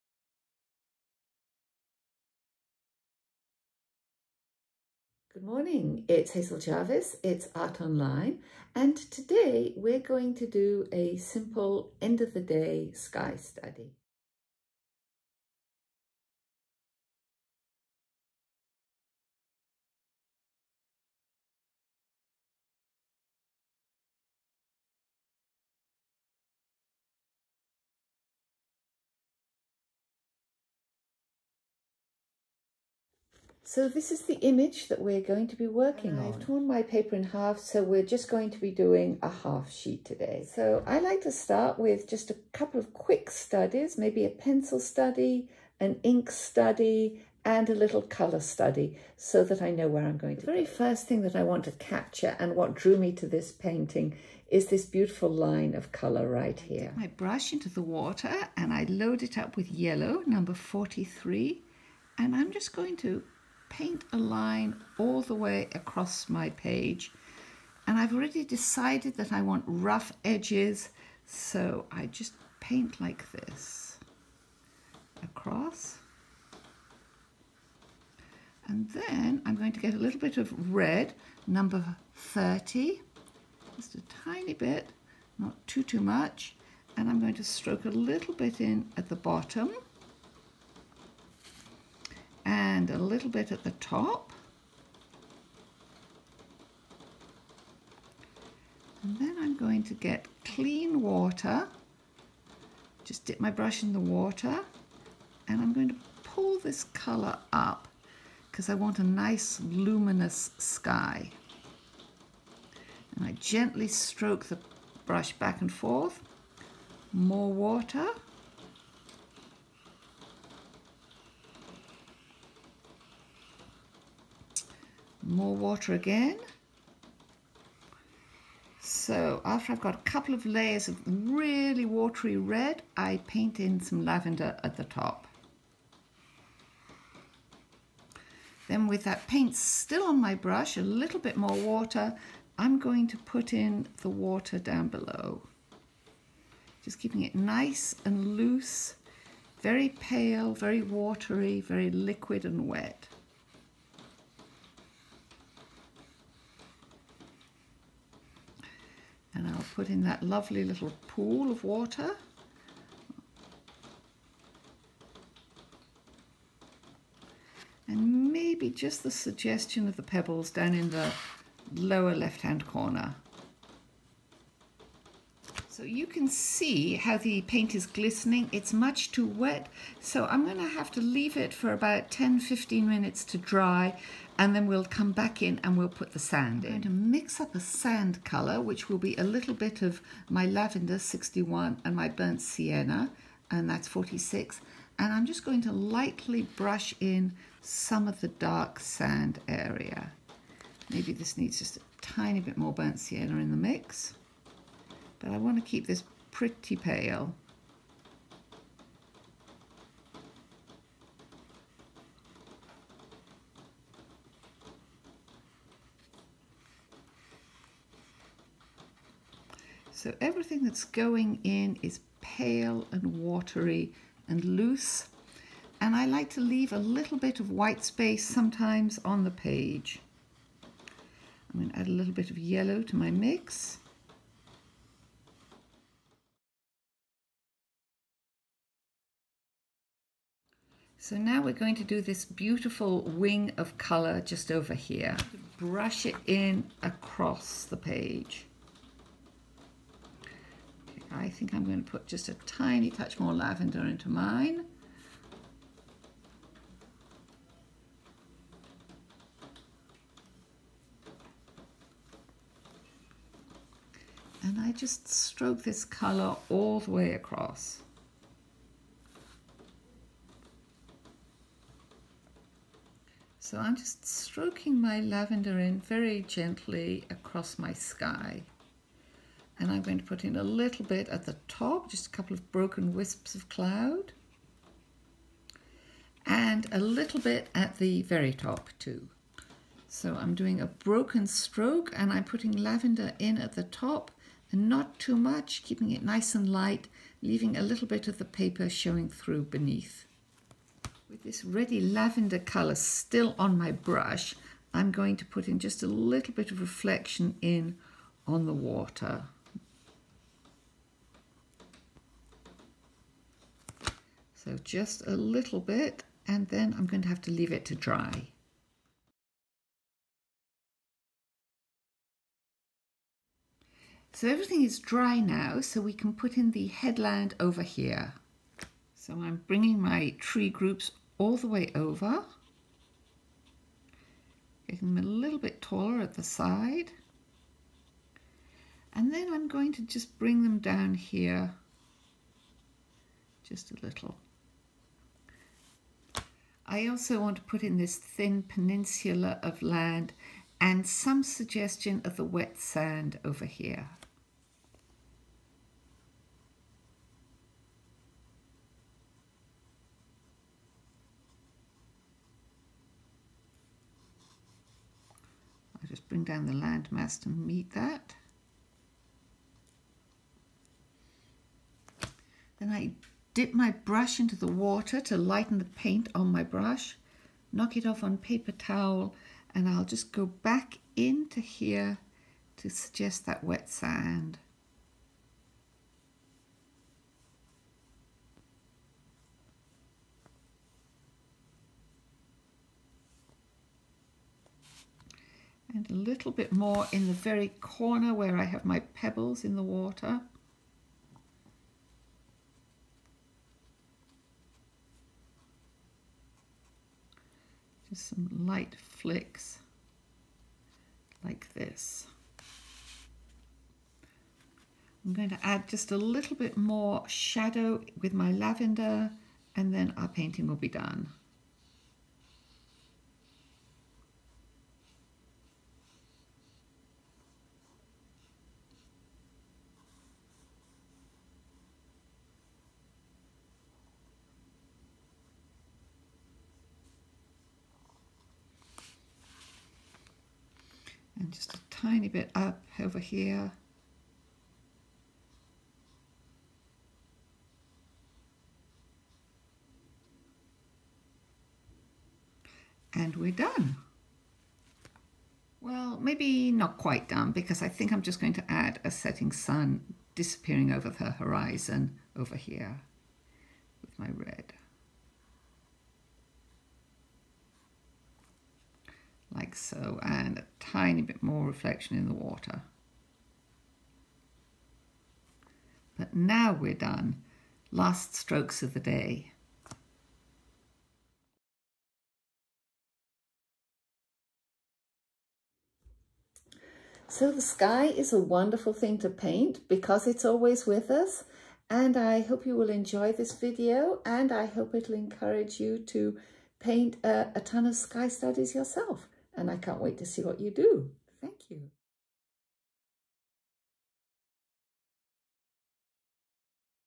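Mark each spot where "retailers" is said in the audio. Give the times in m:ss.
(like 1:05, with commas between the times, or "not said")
not said.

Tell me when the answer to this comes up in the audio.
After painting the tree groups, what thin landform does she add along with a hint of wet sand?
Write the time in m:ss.
5:48.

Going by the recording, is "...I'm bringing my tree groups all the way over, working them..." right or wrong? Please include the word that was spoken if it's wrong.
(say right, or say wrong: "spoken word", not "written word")
wrong: "making", not "working".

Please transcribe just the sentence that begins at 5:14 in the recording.
So just a little bit and then I'm going to have to leave it to dry.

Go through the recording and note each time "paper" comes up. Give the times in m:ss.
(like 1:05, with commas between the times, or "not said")
0:36, 4:58, 6:18.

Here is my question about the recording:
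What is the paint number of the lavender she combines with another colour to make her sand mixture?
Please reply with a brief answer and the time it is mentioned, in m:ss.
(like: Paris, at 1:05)
61, at 3:10.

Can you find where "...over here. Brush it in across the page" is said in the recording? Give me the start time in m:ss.
4:04.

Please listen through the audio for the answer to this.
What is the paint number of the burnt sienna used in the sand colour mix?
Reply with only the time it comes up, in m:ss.
3:13.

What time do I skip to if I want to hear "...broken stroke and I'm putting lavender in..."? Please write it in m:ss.
4:50.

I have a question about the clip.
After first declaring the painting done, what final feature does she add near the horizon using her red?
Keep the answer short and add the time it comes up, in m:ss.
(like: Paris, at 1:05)
setting sun, at 7:38.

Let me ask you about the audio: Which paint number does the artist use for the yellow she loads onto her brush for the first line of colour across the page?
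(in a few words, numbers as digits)
43.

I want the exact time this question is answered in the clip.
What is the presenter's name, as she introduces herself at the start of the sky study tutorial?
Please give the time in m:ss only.
0:06.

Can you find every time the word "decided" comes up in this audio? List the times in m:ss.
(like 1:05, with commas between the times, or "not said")
1:08.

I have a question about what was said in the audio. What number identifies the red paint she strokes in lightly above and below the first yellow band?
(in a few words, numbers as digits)
30.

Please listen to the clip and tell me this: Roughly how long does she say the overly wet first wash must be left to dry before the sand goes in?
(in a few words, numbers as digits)
10-15 minutes.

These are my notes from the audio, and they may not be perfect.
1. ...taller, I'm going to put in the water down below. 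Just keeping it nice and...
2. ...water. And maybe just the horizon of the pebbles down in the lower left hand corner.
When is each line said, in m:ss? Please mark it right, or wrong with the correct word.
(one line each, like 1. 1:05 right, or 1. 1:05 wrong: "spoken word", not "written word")
1. 2:21 wrong: "water", not "taller"
2. 2:41 wrong: "suggestion", not "horizon".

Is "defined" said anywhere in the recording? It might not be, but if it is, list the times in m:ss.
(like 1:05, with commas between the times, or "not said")
not said.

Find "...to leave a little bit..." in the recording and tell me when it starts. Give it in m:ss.
3:46.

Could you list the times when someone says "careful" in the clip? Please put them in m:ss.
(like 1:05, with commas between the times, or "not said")
not said.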